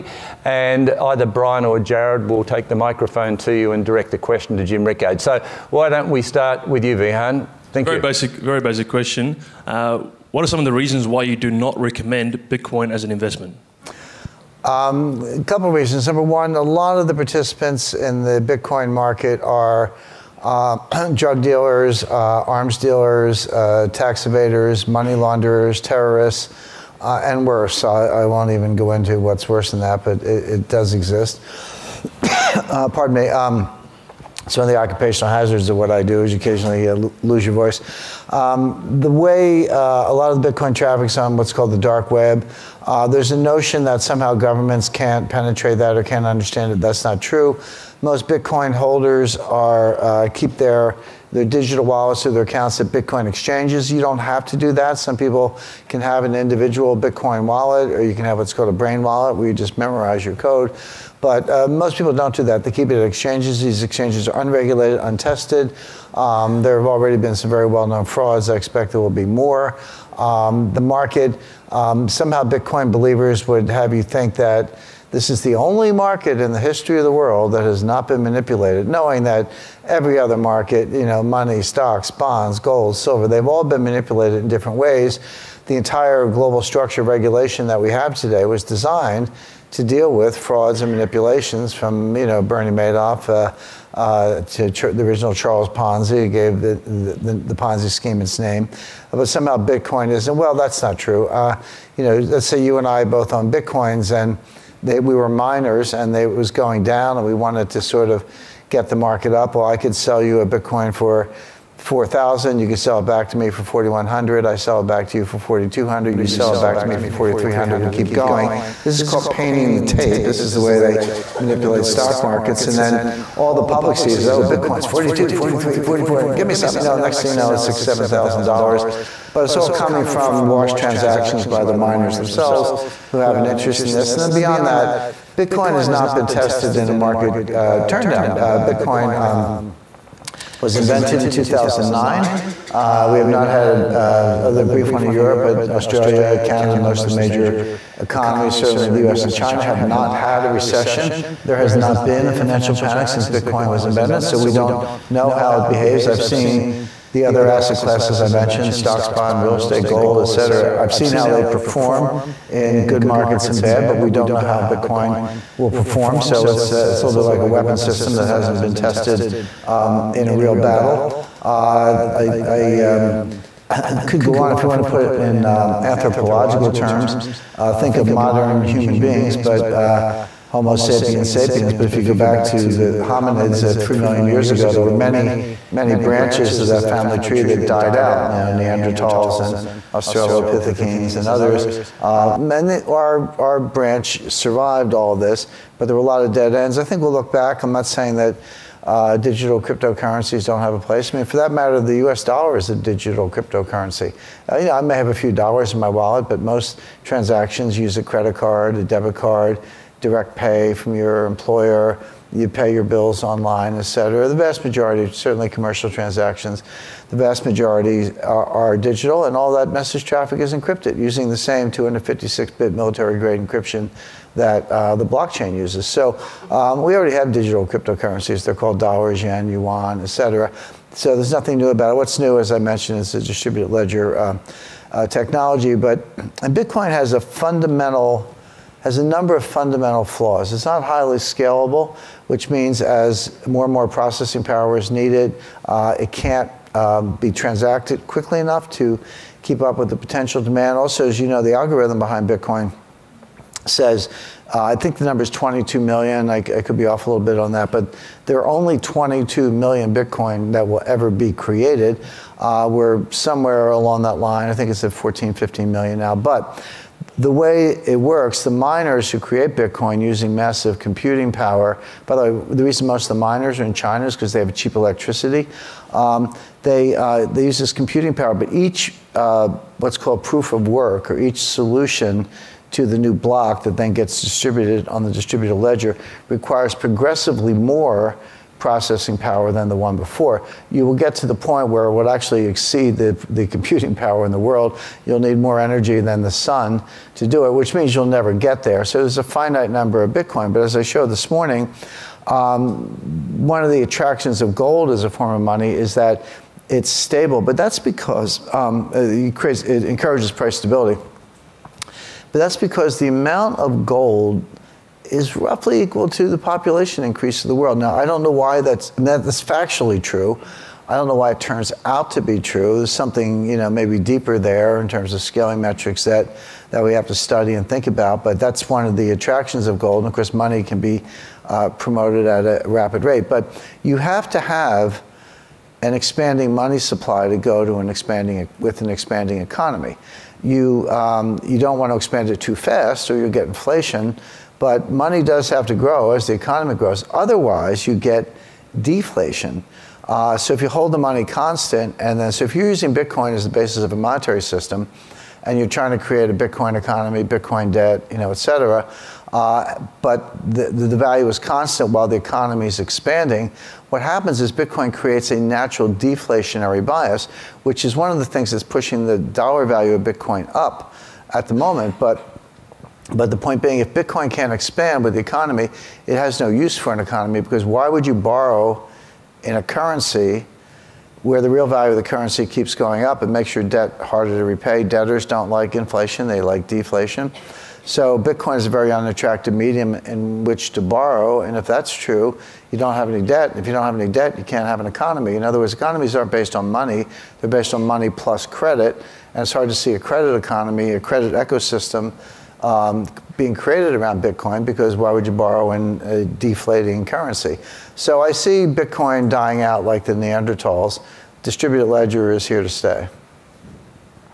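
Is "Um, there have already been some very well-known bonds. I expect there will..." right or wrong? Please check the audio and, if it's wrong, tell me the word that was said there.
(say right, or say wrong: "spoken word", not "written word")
wrong: "frauds", not "bonds".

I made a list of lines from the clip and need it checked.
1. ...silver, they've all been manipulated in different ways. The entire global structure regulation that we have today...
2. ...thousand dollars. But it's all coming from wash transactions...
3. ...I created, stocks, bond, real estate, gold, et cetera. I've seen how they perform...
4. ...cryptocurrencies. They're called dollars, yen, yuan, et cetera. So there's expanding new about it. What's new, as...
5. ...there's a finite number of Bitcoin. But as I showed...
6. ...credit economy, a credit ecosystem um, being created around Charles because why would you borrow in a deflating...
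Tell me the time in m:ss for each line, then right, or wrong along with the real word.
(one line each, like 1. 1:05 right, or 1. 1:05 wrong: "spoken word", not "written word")
1. 1:22 right
2. 2:08 right
3. 2:38 wrong: "mentioned", not "created"
4. 3:47 wrong: "nothing", not "expanding"
5. 4:58 right
6. 6:39 wrong: "Bitcoin", not "Charles".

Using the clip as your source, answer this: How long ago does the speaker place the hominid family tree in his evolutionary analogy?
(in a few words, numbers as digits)
3 million years.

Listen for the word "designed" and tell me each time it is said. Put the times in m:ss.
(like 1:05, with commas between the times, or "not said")
1:28.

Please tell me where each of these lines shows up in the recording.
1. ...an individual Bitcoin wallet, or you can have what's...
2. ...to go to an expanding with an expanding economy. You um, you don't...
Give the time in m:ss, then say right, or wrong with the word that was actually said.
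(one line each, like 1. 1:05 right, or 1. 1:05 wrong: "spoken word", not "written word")
1. 0:56 right
2. 5:37 right.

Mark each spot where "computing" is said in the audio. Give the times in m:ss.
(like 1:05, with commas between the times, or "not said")
4:30, 4:37, 4:53.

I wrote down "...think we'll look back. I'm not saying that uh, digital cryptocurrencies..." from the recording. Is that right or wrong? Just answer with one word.
right.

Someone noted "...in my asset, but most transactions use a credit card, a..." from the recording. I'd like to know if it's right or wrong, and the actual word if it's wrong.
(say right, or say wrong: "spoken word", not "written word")
wrong: "wallet", not "asset".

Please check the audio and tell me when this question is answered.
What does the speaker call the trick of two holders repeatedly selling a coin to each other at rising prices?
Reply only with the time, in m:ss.
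1:59.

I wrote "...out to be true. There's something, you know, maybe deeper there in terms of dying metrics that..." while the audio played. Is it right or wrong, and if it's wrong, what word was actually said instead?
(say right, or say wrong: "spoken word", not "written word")
wrong: "scaling", not "dying".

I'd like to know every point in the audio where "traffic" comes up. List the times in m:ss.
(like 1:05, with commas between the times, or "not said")
0:40, 3:40.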